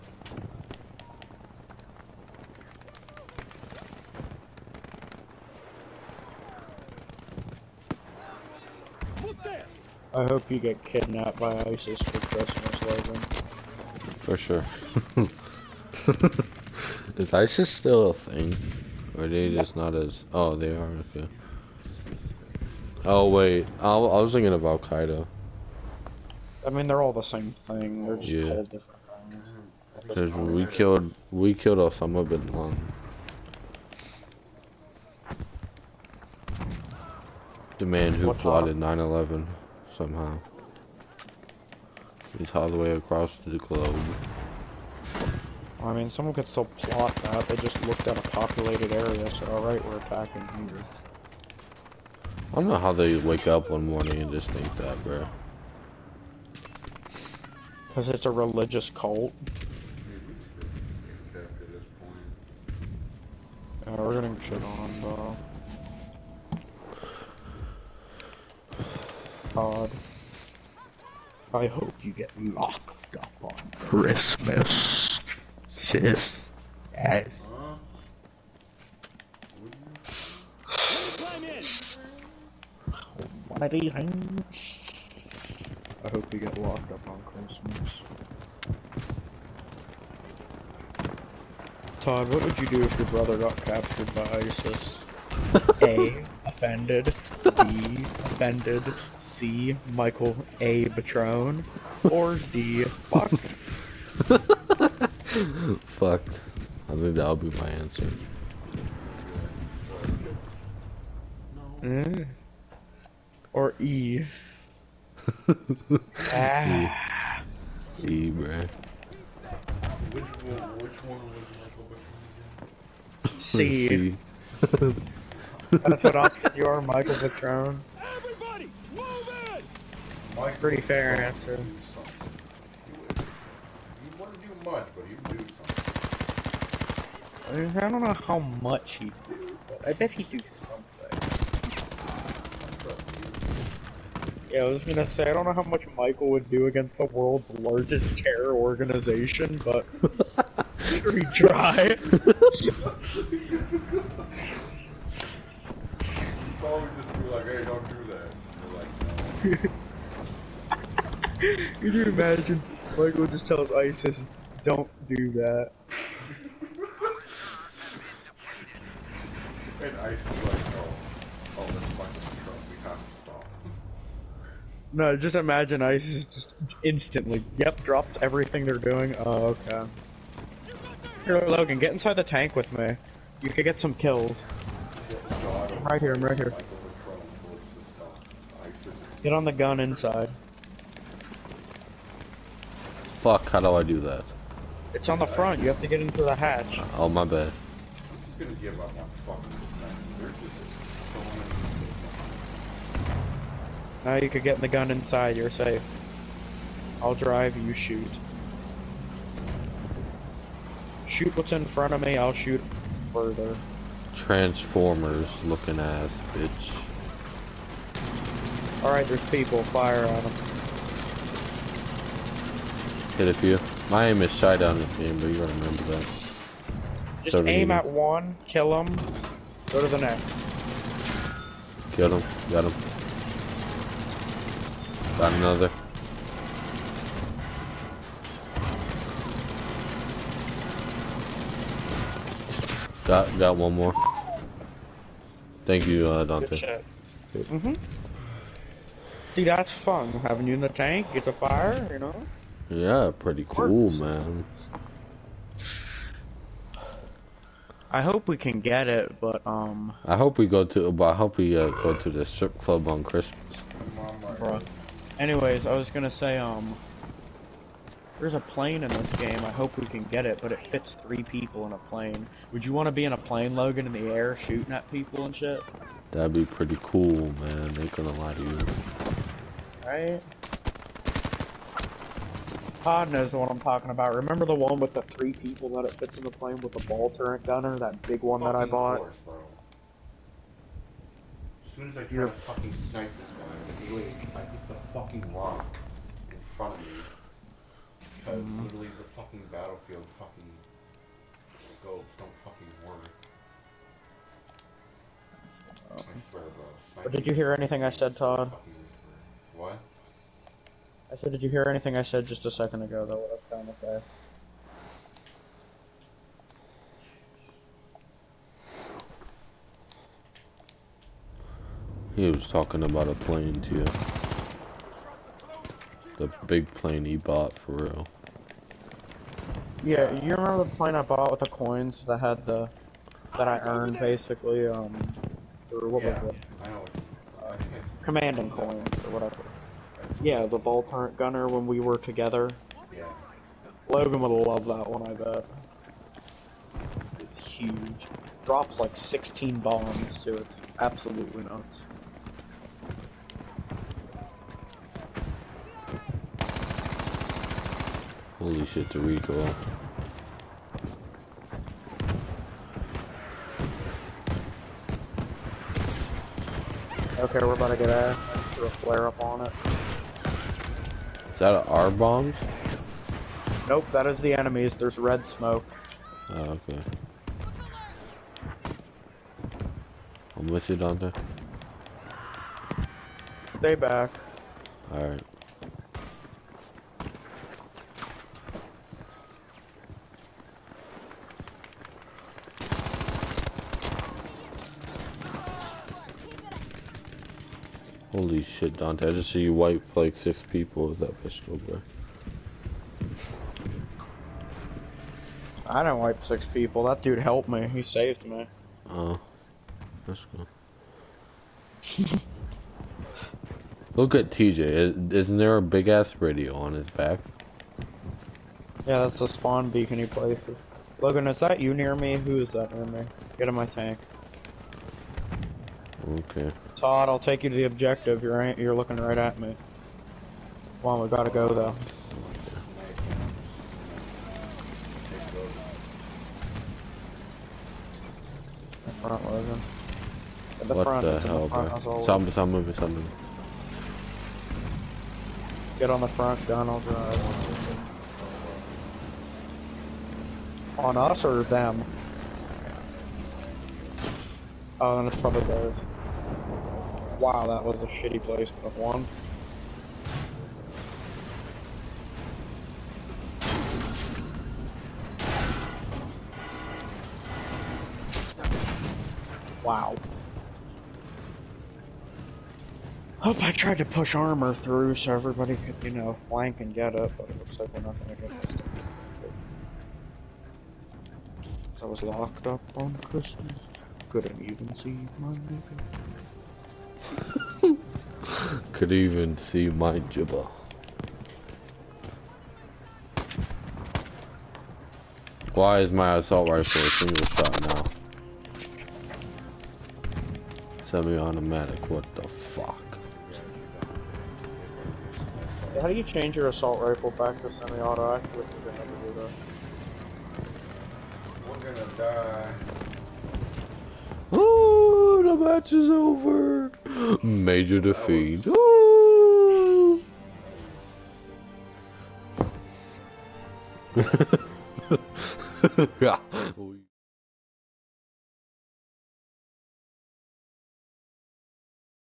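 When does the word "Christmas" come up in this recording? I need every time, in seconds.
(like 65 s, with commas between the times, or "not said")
12 s, 73 s, 87 s, 263 s, 483 s.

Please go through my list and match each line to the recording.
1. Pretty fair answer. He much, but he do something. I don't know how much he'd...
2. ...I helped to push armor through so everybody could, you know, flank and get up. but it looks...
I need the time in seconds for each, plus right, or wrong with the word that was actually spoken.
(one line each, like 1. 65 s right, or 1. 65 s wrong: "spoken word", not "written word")
1. 130 s right
2. 473 s wrong: "tried", not "helped".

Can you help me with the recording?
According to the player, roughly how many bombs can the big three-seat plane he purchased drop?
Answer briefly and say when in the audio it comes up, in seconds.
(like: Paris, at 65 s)
16, at 348 s.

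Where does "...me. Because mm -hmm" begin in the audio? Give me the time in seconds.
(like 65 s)
296 s.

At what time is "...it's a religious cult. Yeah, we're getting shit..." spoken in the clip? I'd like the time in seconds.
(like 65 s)
58 s.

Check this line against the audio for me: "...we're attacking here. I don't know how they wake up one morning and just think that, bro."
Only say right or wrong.
right.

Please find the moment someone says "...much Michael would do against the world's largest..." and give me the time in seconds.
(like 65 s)
145 s.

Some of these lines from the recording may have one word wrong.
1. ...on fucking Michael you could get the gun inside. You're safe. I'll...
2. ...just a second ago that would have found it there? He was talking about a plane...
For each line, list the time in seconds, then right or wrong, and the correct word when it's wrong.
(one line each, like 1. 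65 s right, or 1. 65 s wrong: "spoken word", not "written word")
1. 199 s wrong: "Now", not "Michael"
2. 312 s right.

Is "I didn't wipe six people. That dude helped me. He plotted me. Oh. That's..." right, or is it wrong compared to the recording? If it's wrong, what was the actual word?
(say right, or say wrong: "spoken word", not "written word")
wrong: "saved", not "plotted".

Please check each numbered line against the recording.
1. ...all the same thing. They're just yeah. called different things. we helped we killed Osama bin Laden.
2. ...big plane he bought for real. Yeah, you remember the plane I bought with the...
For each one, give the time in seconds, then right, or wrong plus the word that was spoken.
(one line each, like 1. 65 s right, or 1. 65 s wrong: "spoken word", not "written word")
1. 27 s wrong: "killed", not "helped"
2. 326 s right.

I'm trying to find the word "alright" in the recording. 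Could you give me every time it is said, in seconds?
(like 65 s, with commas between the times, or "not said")
49 s, 218 s, 384 s.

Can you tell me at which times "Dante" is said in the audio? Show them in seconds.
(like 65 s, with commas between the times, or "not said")
246 s, 380 s, 398 s.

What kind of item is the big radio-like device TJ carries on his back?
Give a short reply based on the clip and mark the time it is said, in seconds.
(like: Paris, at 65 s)
Spawn beacon, at 419 s.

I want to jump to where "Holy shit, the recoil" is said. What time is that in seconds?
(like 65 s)
358 s.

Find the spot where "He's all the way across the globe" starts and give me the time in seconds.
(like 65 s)
42 s.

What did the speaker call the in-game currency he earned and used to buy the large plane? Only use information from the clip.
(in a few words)
Commanding coins.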